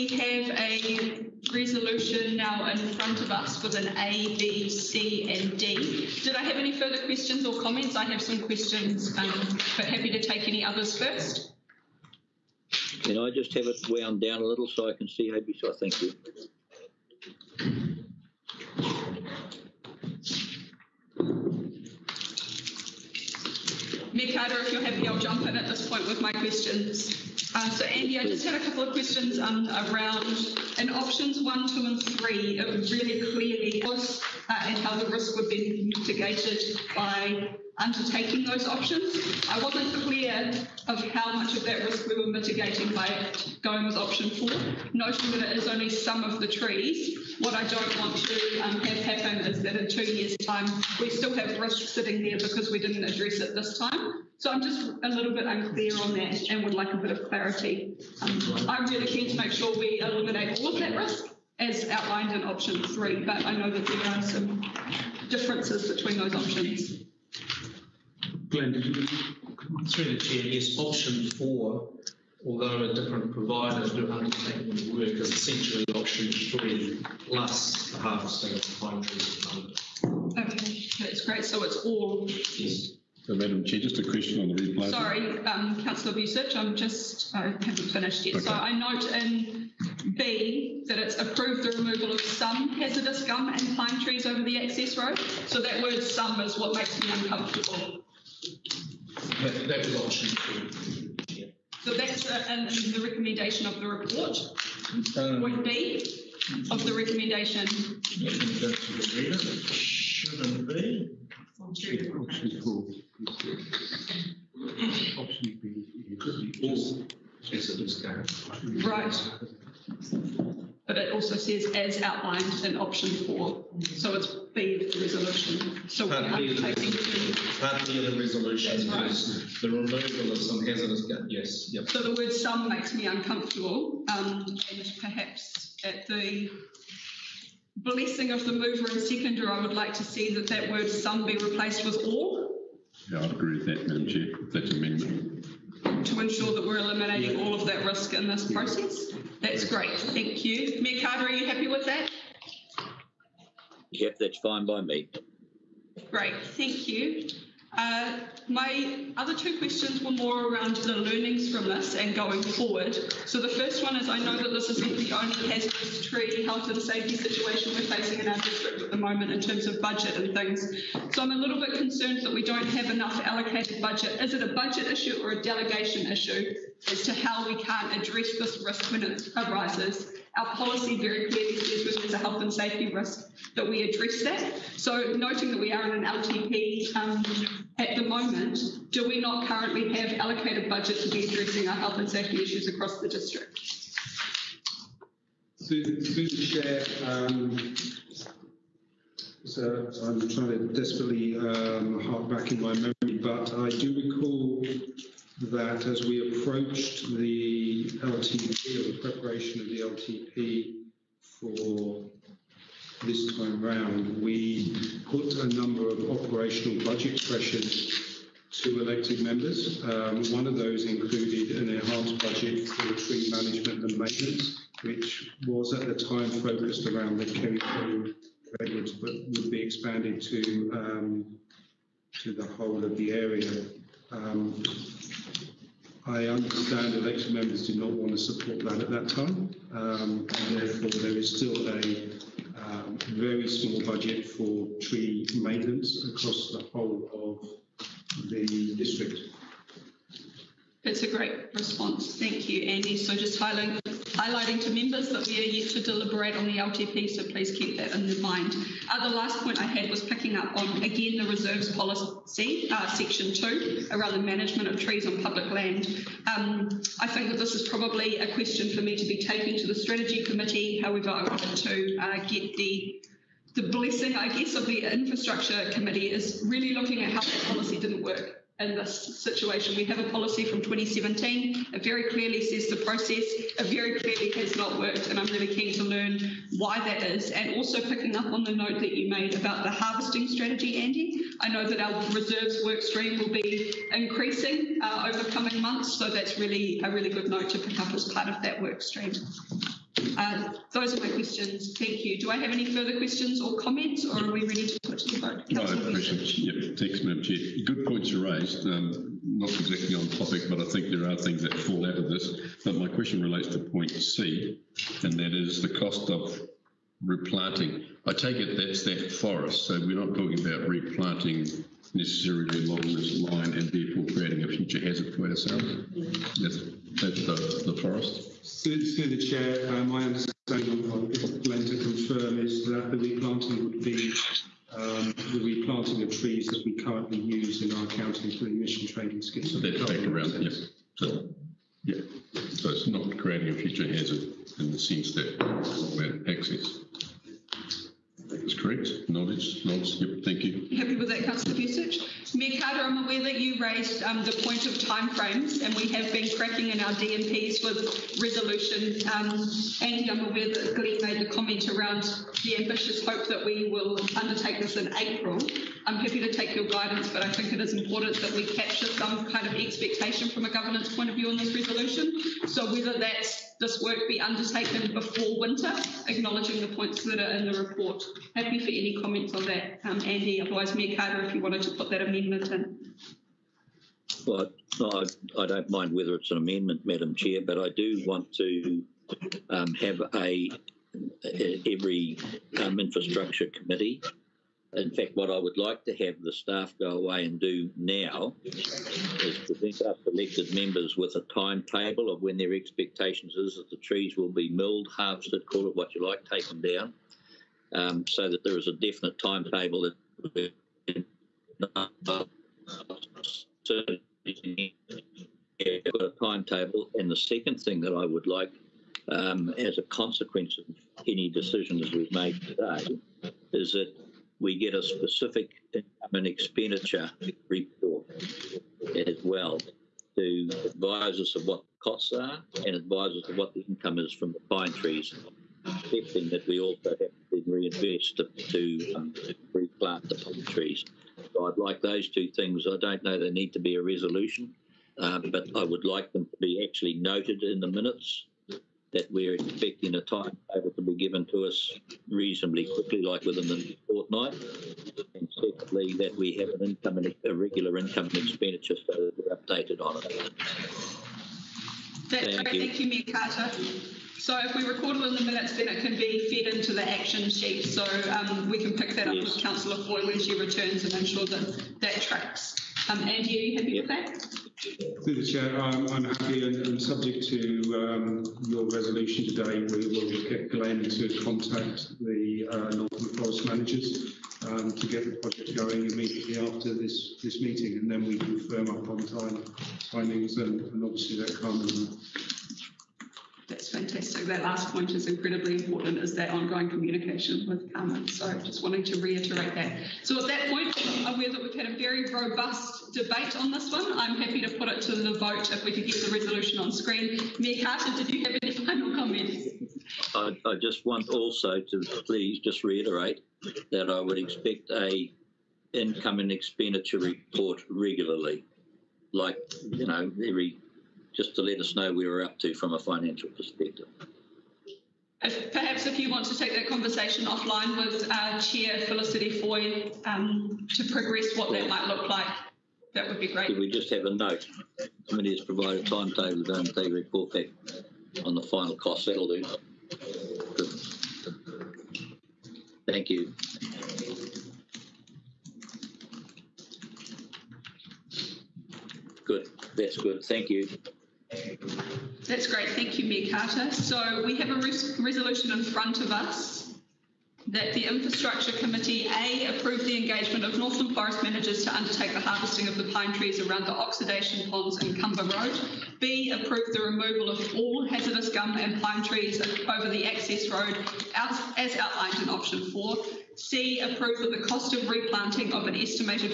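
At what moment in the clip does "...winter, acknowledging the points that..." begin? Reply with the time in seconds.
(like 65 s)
375 s.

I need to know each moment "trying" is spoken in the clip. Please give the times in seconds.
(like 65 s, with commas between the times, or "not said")
200 s.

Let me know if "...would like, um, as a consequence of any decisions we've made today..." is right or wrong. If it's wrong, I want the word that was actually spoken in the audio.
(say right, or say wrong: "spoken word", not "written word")
right.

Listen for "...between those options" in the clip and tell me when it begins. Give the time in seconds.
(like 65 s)
65 s.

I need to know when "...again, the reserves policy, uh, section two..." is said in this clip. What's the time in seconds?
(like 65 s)
260 s.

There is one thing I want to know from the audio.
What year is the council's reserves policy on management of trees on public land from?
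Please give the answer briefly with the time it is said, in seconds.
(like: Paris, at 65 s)
2017, at 280 s.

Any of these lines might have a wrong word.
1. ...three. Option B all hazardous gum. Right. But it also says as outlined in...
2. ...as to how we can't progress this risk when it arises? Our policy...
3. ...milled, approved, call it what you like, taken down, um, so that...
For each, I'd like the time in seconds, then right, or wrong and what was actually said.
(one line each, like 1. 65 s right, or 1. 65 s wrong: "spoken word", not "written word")
1. 112 s wrong: "four", not "three"
2. 176 s wrong: "address", not "progress"
3. 404 s wrong: "harvested", not "approved".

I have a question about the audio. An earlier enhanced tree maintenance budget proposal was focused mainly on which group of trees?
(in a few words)
Kerryford redwoods.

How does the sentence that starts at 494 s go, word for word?
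That last point is incredibly important, is that ongoing communication with Carmen.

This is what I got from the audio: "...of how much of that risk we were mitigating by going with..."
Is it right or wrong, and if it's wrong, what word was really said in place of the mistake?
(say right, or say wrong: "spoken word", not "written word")
right.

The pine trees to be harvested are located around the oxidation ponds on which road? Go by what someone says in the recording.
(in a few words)
Cumber Road.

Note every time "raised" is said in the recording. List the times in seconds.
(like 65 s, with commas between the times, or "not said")
308 s, 353 s.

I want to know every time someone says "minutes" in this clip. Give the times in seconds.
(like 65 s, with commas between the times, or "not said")
447 s, 465 s.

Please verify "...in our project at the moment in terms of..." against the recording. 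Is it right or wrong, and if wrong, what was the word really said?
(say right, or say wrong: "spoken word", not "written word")
wrong: "district", not "project".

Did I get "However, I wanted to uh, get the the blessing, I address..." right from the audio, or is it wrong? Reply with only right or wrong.
wrong.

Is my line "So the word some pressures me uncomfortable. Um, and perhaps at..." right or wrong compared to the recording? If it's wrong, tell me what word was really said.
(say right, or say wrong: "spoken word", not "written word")
wrong: "makes", not "pressures".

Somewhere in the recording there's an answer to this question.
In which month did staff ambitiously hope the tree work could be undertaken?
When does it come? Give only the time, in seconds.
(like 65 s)
364 s.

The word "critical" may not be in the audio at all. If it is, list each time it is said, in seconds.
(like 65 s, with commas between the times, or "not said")
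not said.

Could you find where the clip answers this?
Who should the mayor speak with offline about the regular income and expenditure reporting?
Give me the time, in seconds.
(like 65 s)
528 s.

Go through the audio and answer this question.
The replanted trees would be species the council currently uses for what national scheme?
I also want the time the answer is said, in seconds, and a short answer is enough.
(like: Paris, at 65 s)
emission trading scheme, at 338 s.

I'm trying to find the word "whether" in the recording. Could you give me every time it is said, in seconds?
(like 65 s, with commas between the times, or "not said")
372 s, 385 s.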